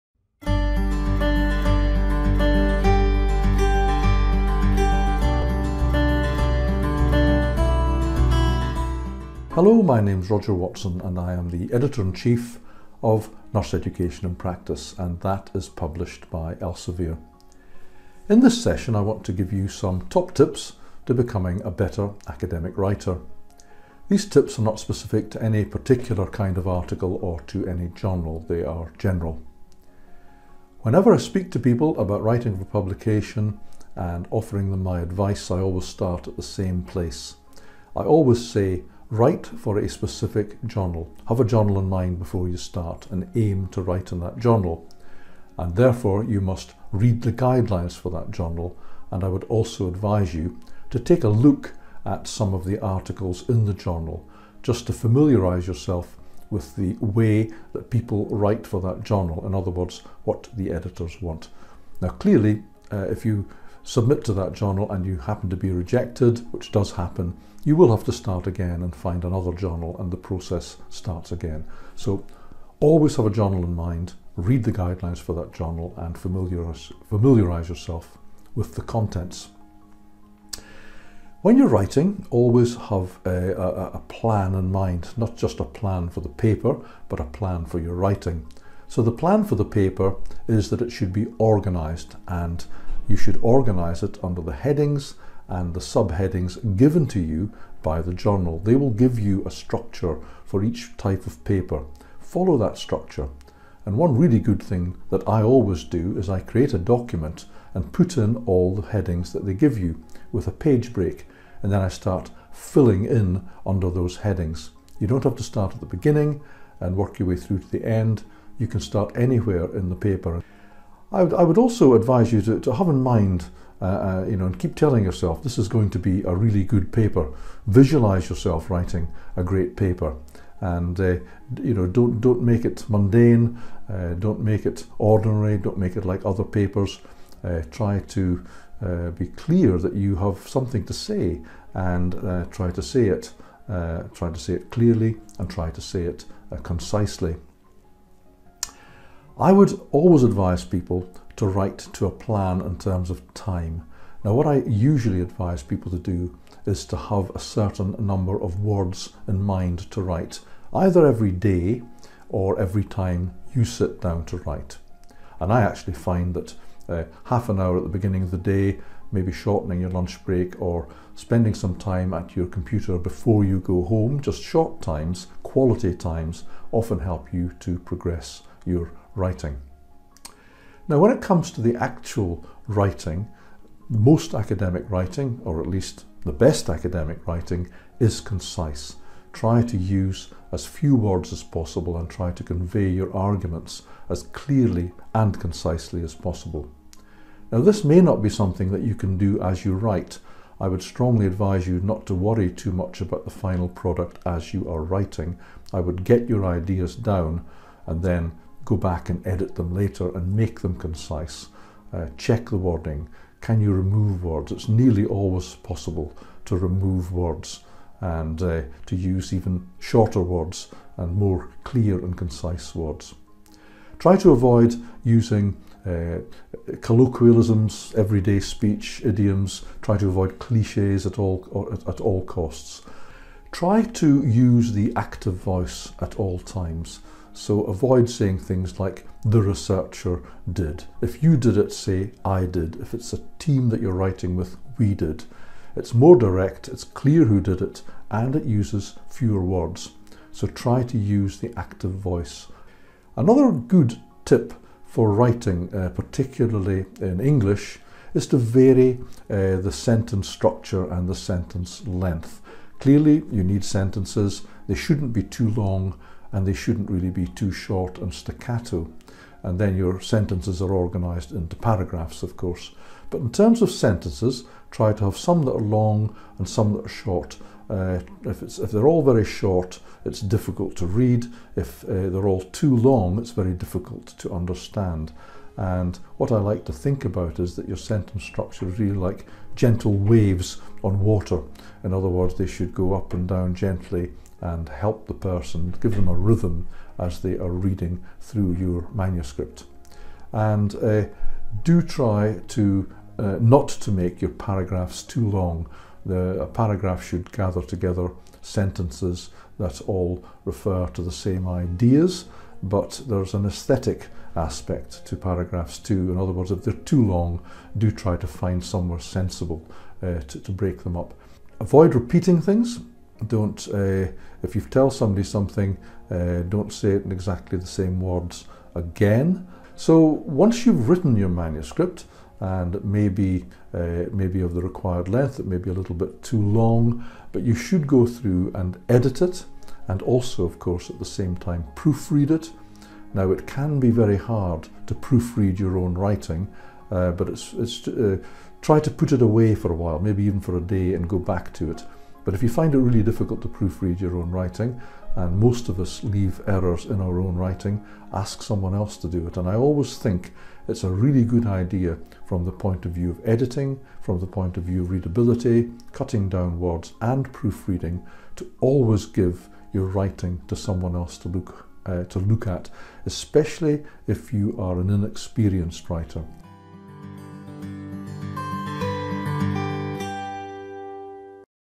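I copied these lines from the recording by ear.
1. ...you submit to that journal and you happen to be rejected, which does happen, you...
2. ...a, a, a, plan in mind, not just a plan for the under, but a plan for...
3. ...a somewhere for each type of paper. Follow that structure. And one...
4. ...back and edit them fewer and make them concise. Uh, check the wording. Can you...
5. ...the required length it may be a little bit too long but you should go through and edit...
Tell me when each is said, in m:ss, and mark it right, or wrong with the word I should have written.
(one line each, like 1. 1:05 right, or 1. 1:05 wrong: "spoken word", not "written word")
1. 1:03 right
2. 1:23 wrong: "paper", not "under"
3. 1:39 wrong: "structure", not "somewhere"
4. 3:28 wrong: "later", not "fewer"
5. 5:34 right.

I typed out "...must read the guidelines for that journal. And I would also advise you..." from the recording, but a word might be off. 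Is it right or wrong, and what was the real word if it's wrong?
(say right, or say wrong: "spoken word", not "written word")
right.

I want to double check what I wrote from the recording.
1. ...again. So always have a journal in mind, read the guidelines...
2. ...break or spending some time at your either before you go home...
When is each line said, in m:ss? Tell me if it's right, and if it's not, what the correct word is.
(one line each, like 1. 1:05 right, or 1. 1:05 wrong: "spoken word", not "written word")
1. 1:11 right
2. 2:50 wrong: "computer", not "either".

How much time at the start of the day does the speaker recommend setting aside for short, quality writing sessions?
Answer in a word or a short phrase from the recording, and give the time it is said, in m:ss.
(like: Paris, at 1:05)
Half an hour, at 2:47.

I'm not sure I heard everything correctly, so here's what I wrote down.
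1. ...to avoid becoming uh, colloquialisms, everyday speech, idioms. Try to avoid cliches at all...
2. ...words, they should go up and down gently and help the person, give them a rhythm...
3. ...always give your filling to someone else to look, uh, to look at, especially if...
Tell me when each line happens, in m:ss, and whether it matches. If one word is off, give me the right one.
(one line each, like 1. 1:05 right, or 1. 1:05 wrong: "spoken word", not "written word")
1. 3:44 wrong: "using", not "becoming"
2. 4:52 right
3. 6:08 wrong: "writing", not "filling".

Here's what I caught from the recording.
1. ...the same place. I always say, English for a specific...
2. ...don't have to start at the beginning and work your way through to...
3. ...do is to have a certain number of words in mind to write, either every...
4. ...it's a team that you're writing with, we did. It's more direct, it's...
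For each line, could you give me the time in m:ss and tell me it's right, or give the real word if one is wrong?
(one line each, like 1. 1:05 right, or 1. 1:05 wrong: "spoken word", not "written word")
1. 0:36 wrong: "Write", not "English"
2. 1:55 right
3. 2:35 right
4. 4:02 right.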